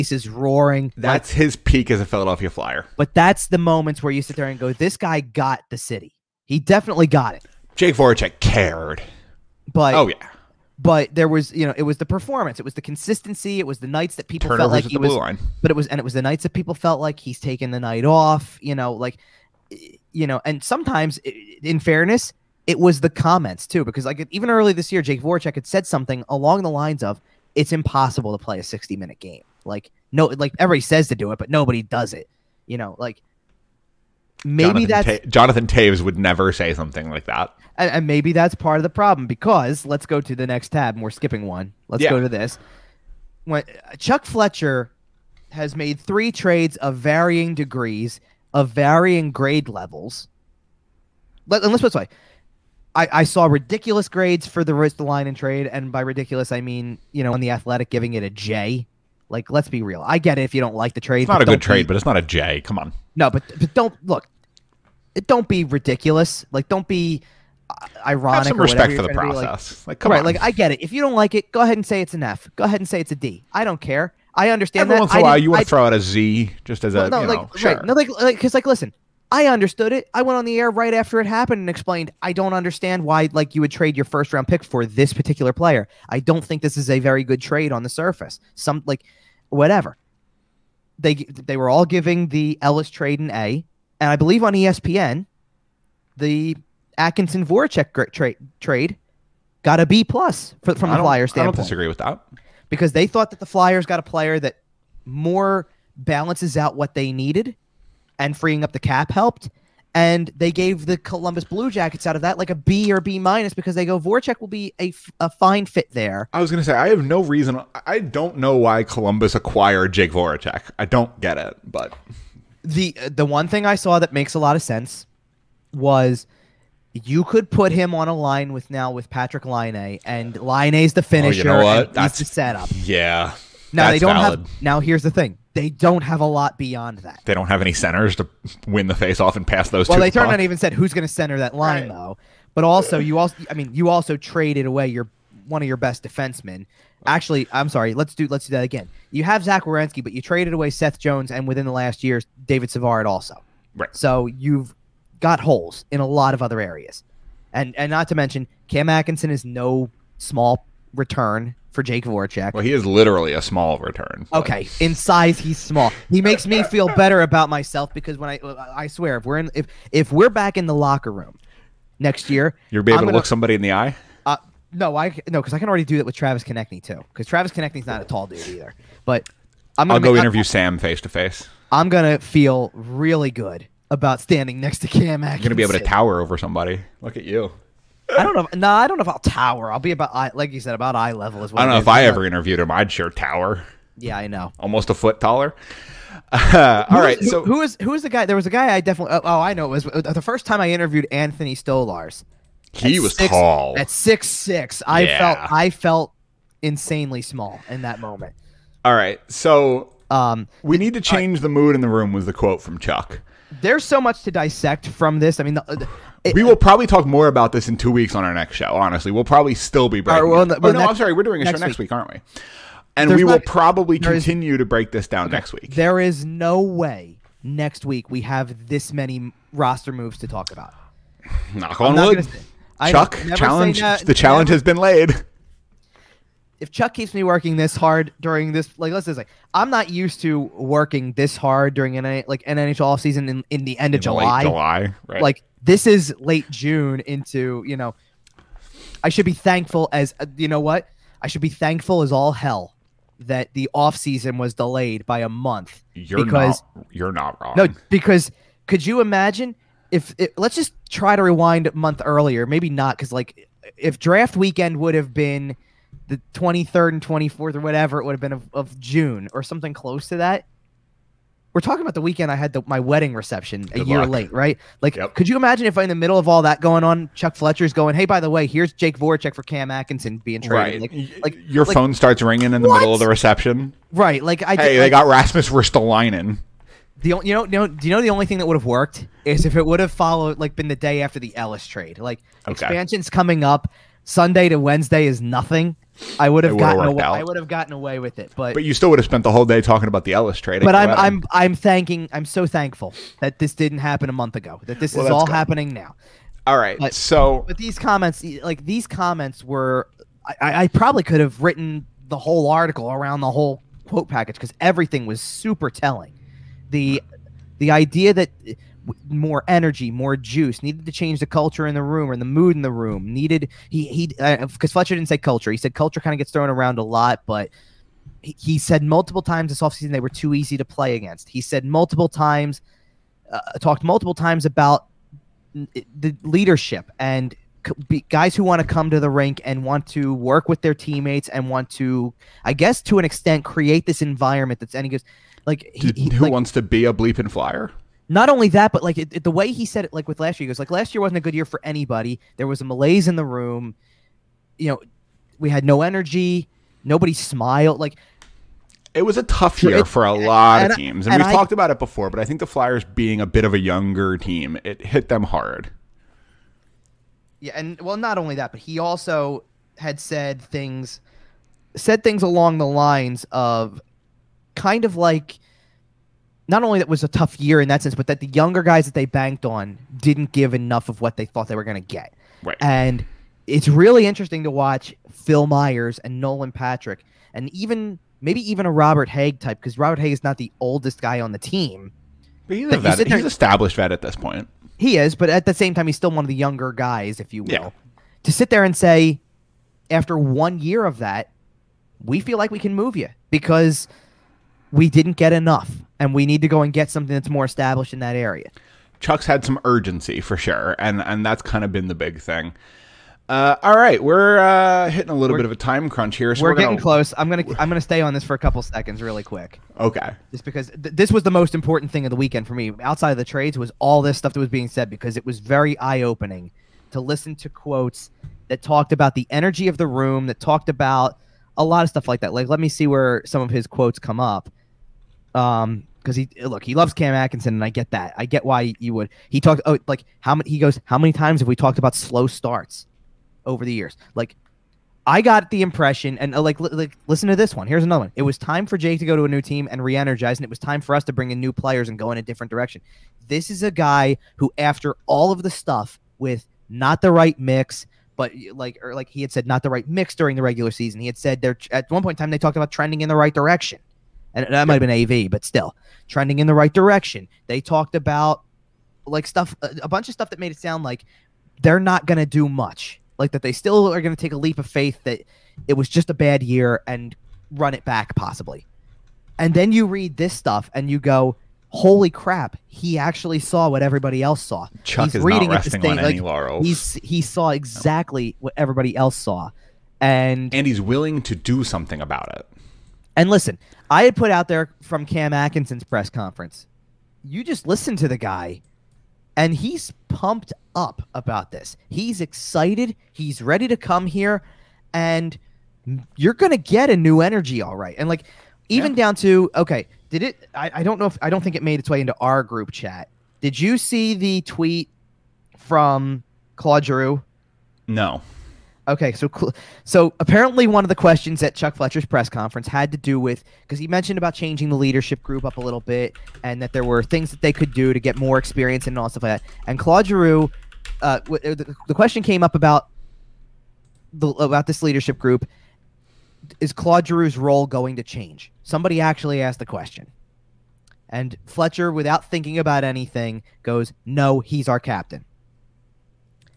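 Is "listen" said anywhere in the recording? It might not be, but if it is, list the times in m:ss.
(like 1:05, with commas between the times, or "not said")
1:18, 7:06, 7:27, 8:13, 8:17.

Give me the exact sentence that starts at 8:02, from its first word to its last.
He actually saw what everybody else saw." Chuck he's is reading not resting on like, any laurels.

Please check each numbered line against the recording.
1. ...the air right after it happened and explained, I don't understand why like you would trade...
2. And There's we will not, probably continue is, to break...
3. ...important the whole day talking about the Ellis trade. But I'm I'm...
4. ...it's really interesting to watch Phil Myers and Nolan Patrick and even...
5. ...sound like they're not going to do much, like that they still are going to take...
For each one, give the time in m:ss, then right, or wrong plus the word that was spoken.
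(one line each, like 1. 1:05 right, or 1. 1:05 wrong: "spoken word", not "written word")
1. 1:20 right
2. 3:42 right
3. 4:59 wrong: "spent", not "important"
4. 6:23 right
5. 7:50 right.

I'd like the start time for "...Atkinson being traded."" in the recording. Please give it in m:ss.
4:39.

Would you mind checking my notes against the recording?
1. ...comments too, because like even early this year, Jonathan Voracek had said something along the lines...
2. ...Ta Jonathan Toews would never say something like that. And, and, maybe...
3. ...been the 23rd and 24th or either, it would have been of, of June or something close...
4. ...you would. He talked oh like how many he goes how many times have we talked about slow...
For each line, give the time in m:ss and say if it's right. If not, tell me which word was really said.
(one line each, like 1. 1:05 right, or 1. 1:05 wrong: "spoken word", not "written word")
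1. 0:23 wrong: "Jake", not "Jonathan"
2. 0:35 right
3. 4:25 wrong: "whatever", not "either"
4. 7:18 right.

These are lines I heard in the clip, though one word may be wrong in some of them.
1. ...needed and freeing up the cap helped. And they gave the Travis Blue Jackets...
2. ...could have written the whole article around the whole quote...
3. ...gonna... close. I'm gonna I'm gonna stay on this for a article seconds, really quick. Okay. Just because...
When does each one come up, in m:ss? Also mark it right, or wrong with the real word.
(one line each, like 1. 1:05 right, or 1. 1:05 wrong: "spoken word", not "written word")
1. 1:47 wrong: "Columbus", not "Travis"
2. 5:11 right
3. 6:56 wrong: "couple", not "article".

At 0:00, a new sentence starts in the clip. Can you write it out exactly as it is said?
That's like, his peak as a Philadelphia Flyer.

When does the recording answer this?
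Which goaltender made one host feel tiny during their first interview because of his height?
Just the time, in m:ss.
3:21.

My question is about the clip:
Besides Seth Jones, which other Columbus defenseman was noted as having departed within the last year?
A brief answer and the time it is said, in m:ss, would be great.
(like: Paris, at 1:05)
David Savard, at 2:32.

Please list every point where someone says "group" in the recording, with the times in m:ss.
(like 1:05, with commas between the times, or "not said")
8:32, 8:45, 8:55.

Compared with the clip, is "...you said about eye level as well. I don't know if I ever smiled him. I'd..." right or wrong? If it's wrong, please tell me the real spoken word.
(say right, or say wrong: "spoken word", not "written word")
wrong: "interviewed", not "smiled".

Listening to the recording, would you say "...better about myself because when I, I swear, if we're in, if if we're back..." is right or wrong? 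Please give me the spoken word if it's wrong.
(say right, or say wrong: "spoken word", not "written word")
right.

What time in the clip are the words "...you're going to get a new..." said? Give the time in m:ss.
8:26.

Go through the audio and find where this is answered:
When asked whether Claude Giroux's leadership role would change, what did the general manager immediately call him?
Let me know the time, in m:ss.
9:04.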